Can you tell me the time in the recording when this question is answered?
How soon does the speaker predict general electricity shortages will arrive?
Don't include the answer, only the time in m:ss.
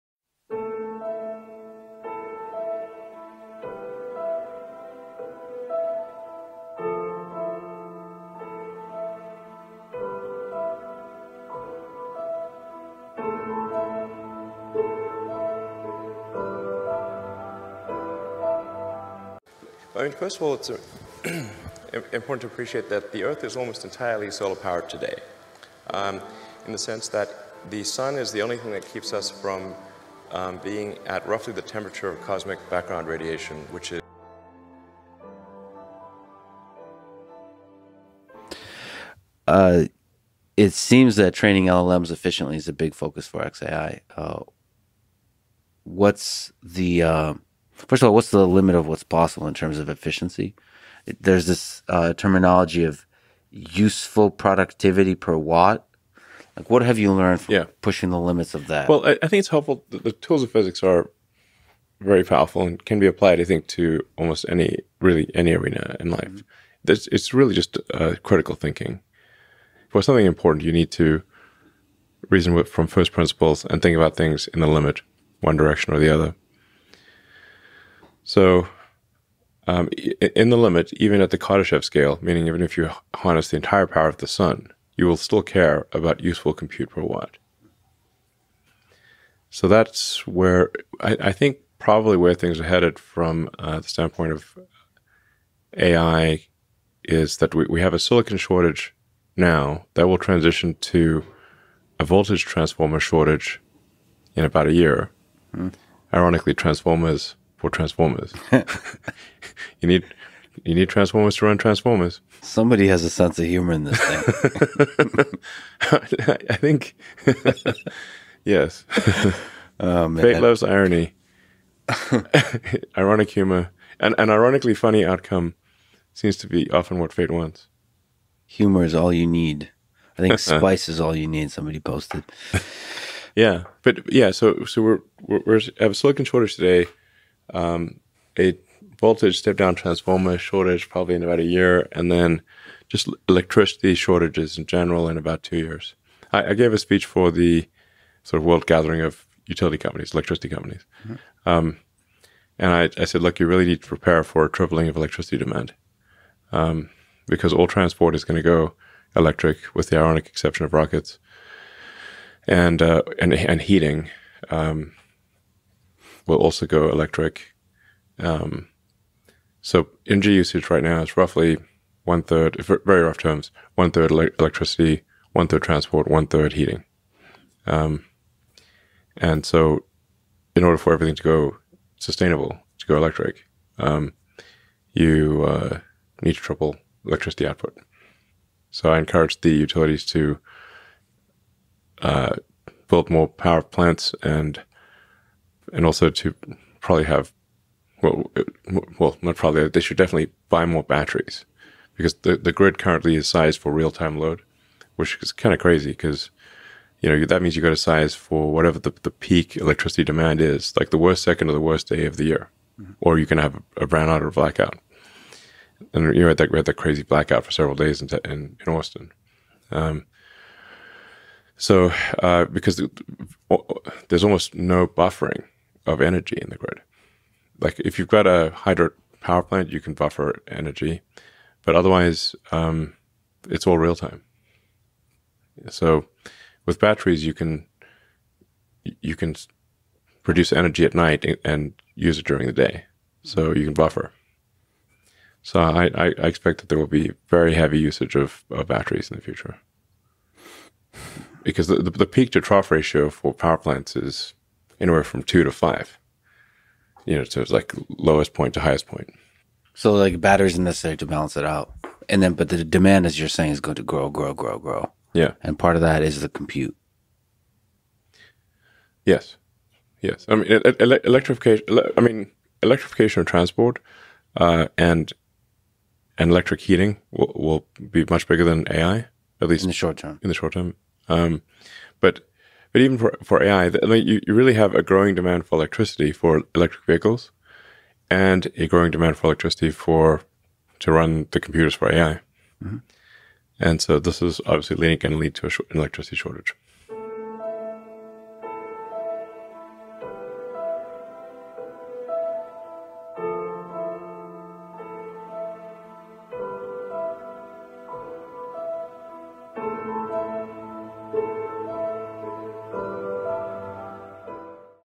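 2:25.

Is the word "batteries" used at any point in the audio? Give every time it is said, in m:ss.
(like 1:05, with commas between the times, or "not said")
3:20, 3:56, 4:08, 4:20.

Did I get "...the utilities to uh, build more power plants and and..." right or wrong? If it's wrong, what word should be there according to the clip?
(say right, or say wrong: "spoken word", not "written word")
right.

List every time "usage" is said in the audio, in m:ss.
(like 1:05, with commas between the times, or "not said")
2:50, 4:07.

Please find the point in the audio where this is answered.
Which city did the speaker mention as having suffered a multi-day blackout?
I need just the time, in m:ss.
3:38.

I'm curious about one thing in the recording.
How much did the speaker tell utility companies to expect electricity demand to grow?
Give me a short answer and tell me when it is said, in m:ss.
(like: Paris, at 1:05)
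tripling, at 2:34.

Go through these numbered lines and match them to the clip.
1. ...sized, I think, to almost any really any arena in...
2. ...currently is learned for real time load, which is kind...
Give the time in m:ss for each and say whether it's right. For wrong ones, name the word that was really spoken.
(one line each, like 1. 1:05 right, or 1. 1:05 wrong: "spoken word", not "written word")
1. 1:03 wrong: "applied", not "sized"
2. 3:22 wrong: "sized", not "learned".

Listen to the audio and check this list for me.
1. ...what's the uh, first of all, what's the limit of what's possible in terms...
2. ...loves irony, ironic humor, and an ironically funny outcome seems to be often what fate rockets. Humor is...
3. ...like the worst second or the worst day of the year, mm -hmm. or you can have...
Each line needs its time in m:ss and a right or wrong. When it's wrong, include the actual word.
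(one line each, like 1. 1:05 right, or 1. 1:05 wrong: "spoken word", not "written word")
1. 0:45 right
2. 2:00 wrong: "wants", not "rockets"
3. 3:30 right.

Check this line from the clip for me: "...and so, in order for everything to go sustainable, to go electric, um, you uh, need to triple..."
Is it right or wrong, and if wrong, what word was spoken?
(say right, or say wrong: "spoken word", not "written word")
right.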